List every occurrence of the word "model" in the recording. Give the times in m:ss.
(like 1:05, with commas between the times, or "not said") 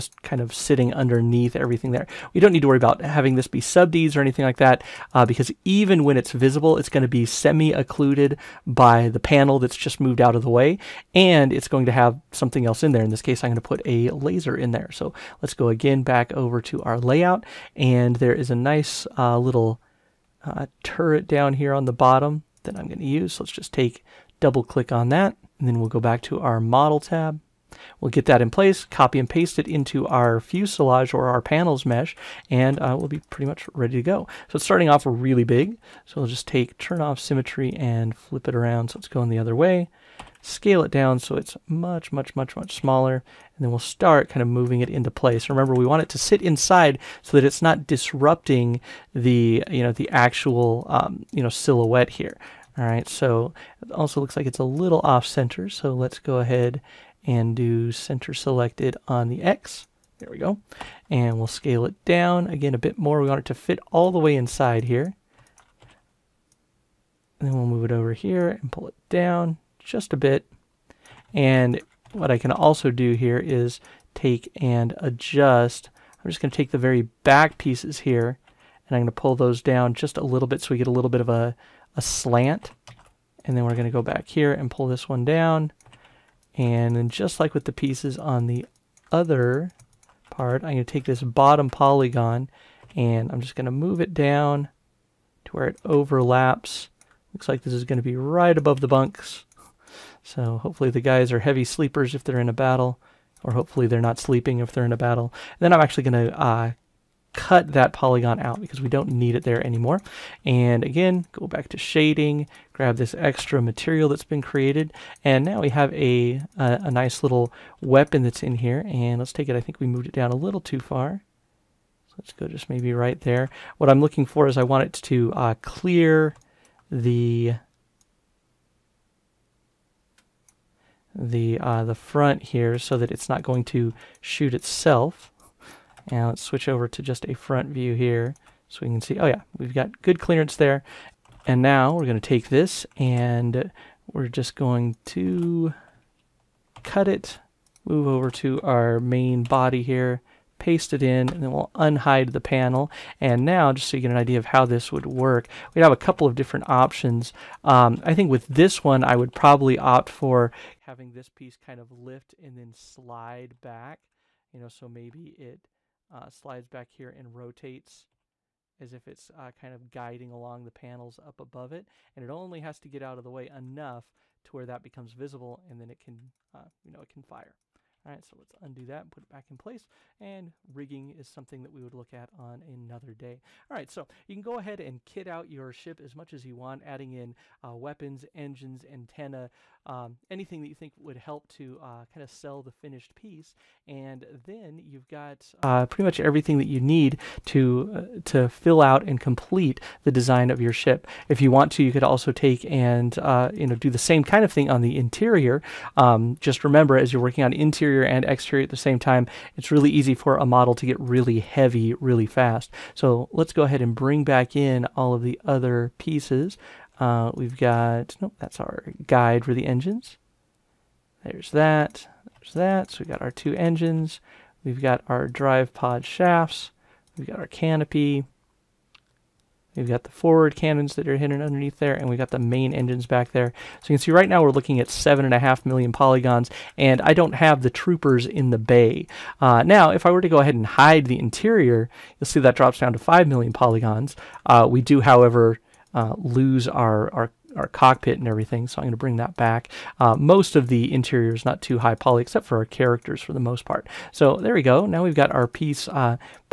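0:26, 3:30.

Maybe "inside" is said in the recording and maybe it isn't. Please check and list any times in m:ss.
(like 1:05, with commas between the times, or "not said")
0:46, 1:04.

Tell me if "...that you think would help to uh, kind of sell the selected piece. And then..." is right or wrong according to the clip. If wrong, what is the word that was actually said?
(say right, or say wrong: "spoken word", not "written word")
wrong: "finished", not "selected".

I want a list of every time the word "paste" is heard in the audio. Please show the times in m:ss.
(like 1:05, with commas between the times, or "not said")
0:29, 2:30.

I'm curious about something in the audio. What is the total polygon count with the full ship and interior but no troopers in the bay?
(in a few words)
7.5 million.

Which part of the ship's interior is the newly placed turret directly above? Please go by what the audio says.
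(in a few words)
the bunks.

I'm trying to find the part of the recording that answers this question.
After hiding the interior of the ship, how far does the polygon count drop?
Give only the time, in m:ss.
4:02.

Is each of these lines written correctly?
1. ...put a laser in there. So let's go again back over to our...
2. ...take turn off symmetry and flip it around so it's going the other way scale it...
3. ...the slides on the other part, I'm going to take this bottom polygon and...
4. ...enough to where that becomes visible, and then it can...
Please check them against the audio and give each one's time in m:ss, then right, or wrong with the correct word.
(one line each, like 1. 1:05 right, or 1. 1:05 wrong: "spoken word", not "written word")
1. 0:13 right
2. 0:36 right
3. 1:27 wrong: "pieces", not "slides"
4. 2:53 right.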